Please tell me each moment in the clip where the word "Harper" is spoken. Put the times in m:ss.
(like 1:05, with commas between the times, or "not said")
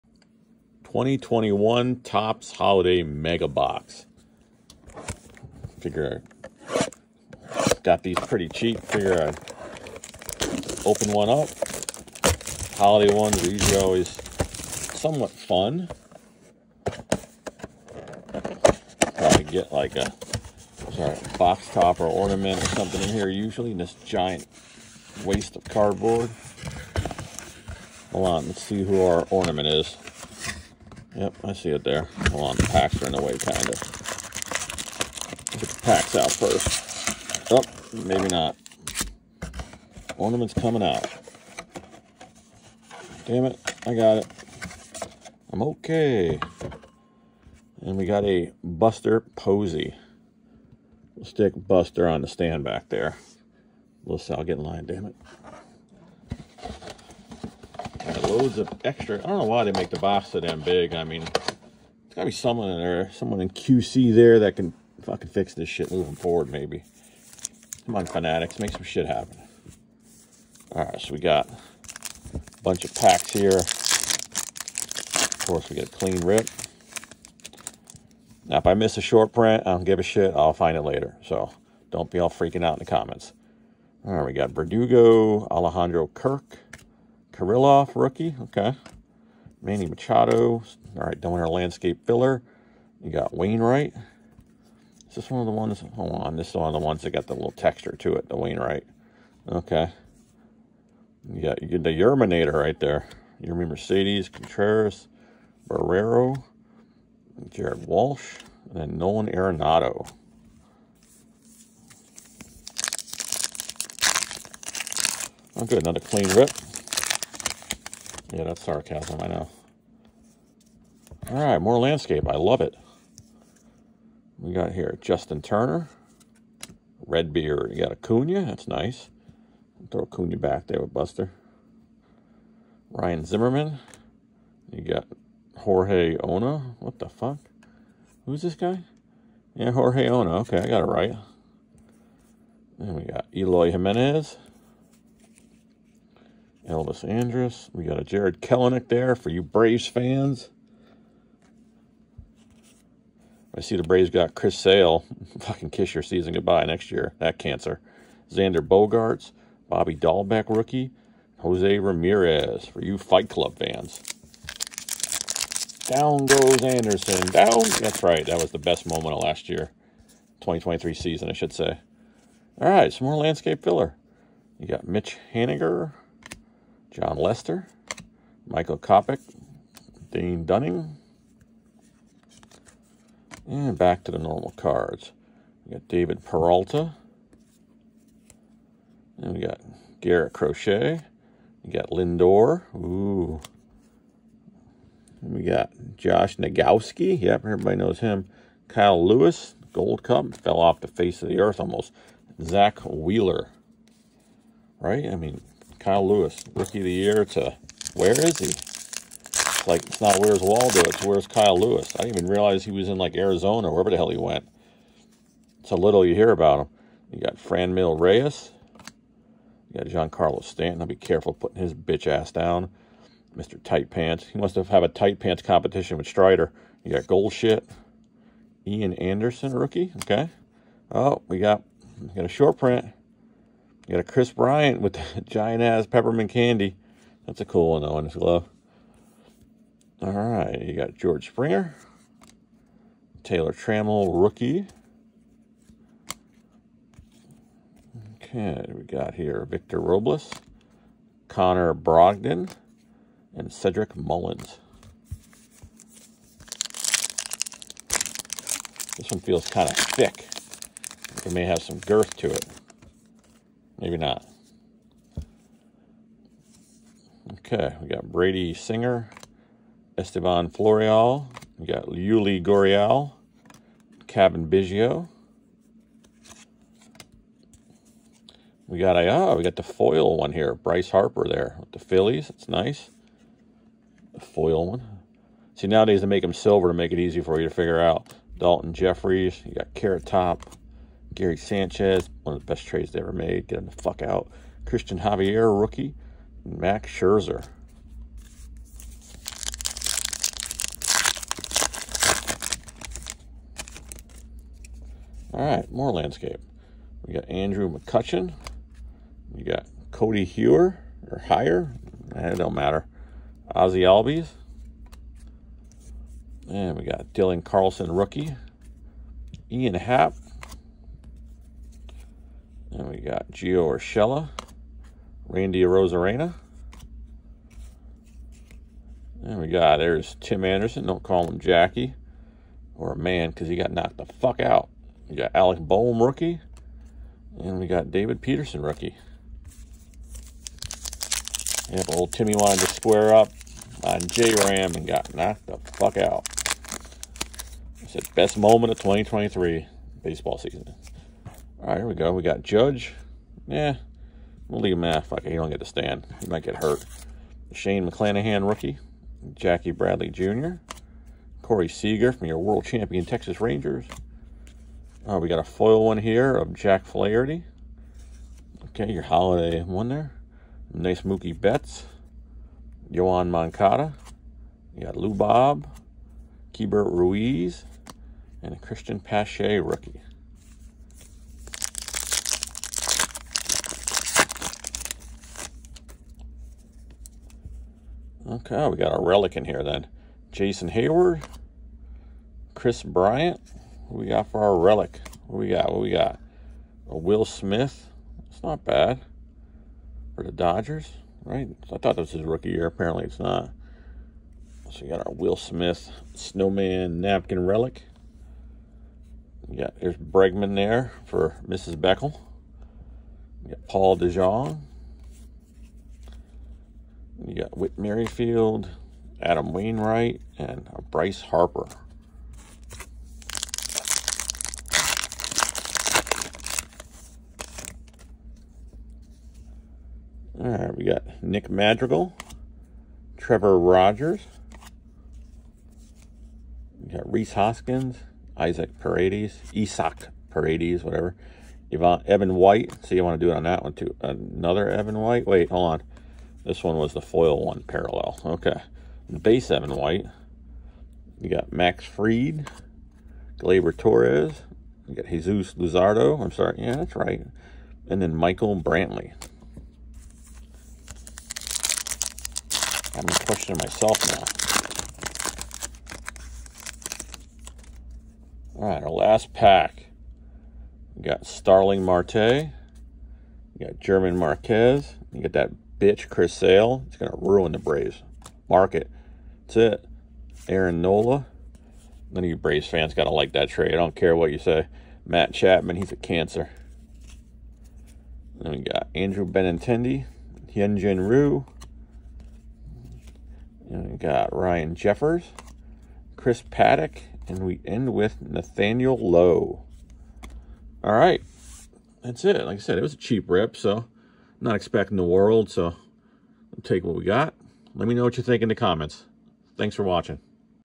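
4:40, 7:01.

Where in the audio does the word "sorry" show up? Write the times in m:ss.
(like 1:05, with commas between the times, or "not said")
0:20, 7:36.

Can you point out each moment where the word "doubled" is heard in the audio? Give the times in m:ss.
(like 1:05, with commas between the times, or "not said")
not said.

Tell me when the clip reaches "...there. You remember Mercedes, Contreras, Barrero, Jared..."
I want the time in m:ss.
1:42.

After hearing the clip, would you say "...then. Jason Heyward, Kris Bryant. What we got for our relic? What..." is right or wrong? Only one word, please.
right.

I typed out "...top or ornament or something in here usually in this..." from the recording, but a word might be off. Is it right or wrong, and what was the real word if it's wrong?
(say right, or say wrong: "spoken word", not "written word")
right.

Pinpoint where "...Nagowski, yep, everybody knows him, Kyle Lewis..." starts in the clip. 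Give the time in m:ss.
3:16.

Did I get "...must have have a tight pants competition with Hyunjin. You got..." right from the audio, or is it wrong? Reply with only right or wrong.
wrong.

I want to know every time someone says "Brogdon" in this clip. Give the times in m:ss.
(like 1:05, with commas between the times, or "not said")
4:11.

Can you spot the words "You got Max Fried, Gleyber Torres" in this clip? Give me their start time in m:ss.
7:31.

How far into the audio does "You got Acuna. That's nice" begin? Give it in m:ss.
2:07.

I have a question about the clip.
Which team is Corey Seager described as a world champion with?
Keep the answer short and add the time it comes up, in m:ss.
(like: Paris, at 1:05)
Texas Rangers, at 6:03.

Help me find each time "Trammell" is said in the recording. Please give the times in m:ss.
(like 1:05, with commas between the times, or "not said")
4:03.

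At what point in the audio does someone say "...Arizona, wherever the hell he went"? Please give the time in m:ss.
3:33.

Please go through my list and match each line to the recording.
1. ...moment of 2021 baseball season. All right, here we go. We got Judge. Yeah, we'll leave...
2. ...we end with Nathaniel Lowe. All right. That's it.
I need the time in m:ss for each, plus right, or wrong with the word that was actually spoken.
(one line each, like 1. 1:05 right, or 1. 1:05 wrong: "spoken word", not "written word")
1. 5:48 wrong: "2023", not "2021"
2. 8:17 right.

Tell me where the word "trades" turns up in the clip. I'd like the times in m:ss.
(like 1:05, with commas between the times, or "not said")
4:52, 8:03.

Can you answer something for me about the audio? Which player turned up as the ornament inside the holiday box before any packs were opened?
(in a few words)
Buster Posey.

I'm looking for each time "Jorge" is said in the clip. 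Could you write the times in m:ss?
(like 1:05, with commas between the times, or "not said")
2:15, 2:19.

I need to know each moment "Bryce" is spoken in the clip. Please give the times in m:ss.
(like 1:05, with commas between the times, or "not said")
4:40, 7:00.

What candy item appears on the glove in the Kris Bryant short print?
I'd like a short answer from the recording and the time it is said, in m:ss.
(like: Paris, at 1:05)
peppermint candy, at 3:55.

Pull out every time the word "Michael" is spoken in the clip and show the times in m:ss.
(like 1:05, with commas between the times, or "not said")
2:58, 7:38.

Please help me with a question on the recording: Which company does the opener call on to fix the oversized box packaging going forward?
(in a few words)
Fanatics.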